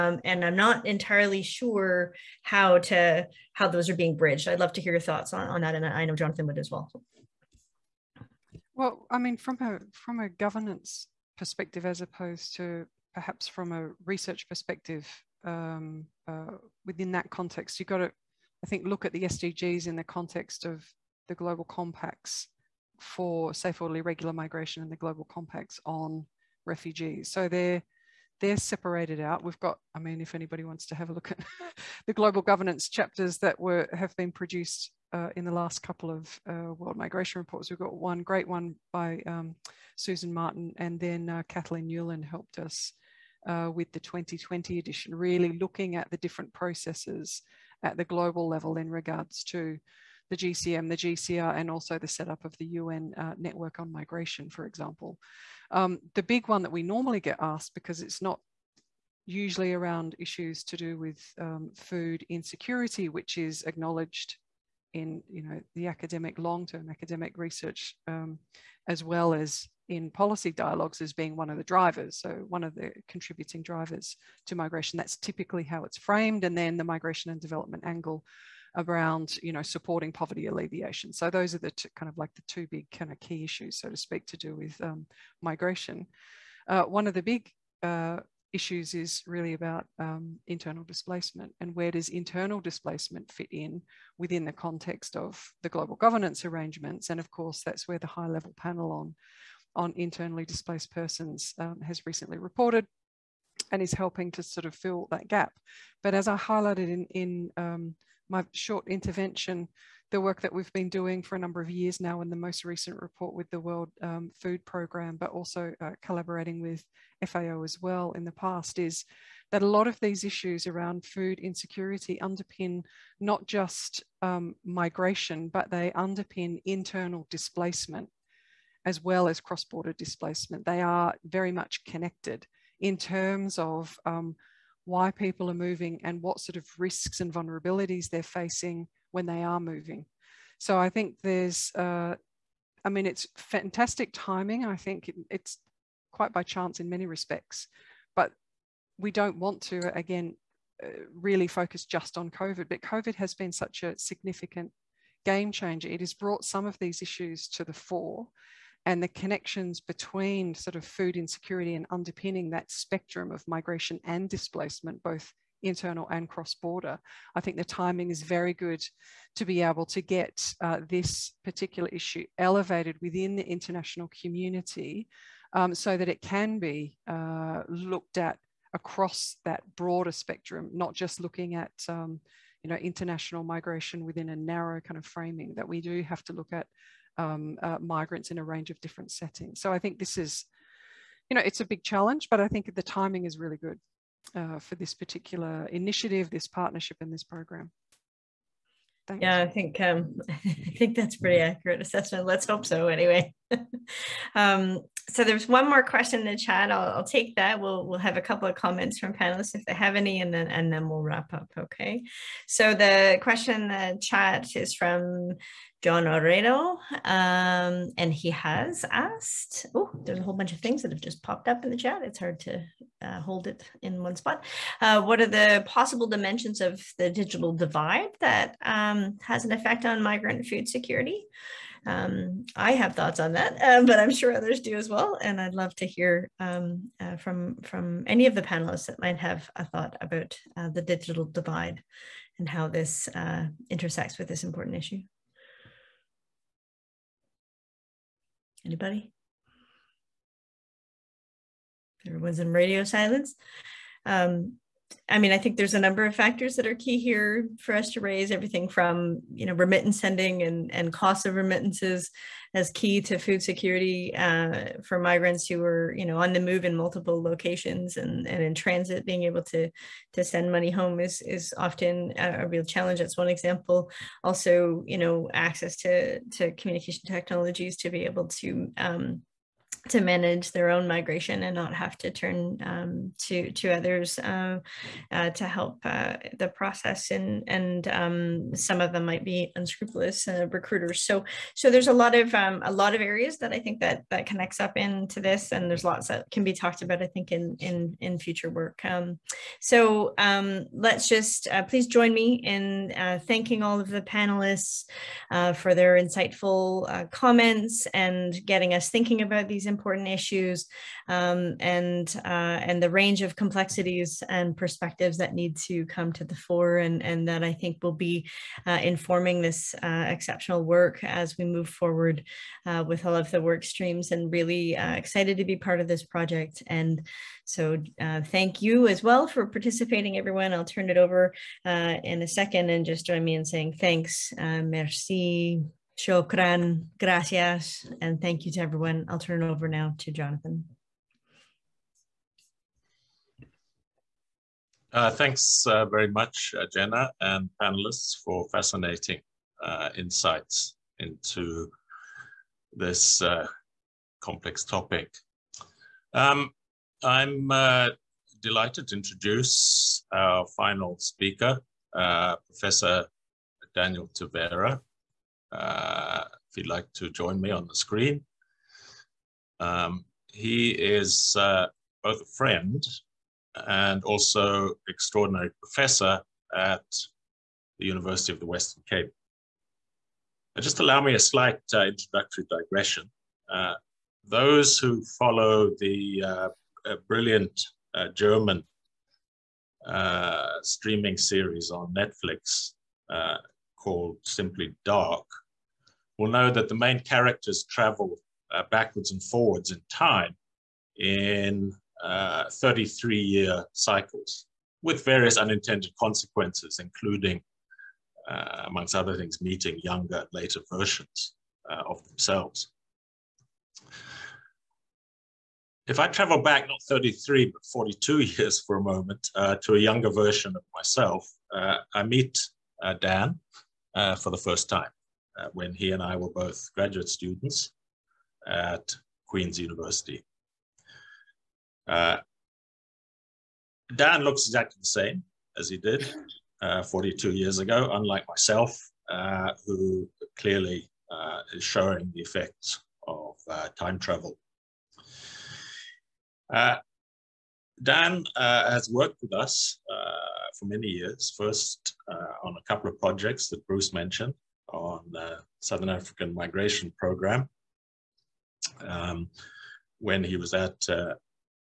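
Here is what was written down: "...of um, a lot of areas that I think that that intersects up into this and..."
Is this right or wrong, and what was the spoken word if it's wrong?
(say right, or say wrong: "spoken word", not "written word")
wrong: "connects", not "intersects".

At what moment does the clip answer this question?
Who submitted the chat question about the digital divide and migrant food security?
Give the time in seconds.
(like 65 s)
215 s.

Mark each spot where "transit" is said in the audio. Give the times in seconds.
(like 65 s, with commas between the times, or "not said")
268 s.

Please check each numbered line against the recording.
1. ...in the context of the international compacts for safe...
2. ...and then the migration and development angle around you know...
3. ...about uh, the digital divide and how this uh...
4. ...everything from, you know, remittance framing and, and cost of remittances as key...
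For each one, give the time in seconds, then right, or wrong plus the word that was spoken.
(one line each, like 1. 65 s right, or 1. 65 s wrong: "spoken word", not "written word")
1. 19 s wrong: "global", not "international"
2. 76 s right
3. 240 s right
4. 258 s wrong: "sending", not "framing".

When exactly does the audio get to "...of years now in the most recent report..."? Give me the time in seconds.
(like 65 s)
111 s.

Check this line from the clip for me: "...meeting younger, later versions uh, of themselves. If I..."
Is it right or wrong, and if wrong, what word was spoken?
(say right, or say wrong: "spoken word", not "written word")
right.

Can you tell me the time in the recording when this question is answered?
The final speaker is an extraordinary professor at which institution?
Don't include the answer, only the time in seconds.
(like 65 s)
377 s.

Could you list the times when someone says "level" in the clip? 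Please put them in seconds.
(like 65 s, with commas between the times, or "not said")
48 s, 98 s.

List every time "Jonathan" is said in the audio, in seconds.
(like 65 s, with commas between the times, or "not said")
6 s, 340 s.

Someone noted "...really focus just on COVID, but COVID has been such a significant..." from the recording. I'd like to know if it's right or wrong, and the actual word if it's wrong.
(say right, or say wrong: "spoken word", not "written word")
right.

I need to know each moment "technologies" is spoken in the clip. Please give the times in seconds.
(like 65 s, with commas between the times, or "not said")
277 s.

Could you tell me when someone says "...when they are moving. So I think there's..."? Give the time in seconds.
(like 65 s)
139 s.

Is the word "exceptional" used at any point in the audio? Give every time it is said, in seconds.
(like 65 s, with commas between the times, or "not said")
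320 s.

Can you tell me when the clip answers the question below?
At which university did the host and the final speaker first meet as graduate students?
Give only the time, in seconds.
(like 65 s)
429 s.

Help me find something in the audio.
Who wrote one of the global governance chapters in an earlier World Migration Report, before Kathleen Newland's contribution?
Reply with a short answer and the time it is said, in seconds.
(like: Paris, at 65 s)
Susan Martin, at 39 s.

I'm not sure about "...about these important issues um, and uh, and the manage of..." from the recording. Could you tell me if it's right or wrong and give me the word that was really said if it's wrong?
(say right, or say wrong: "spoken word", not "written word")
wrong: "range", not "manage".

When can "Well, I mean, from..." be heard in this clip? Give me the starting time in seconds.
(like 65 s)
8 s.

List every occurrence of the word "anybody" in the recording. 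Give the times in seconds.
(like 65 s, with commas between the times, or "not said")
30 s, 248 s.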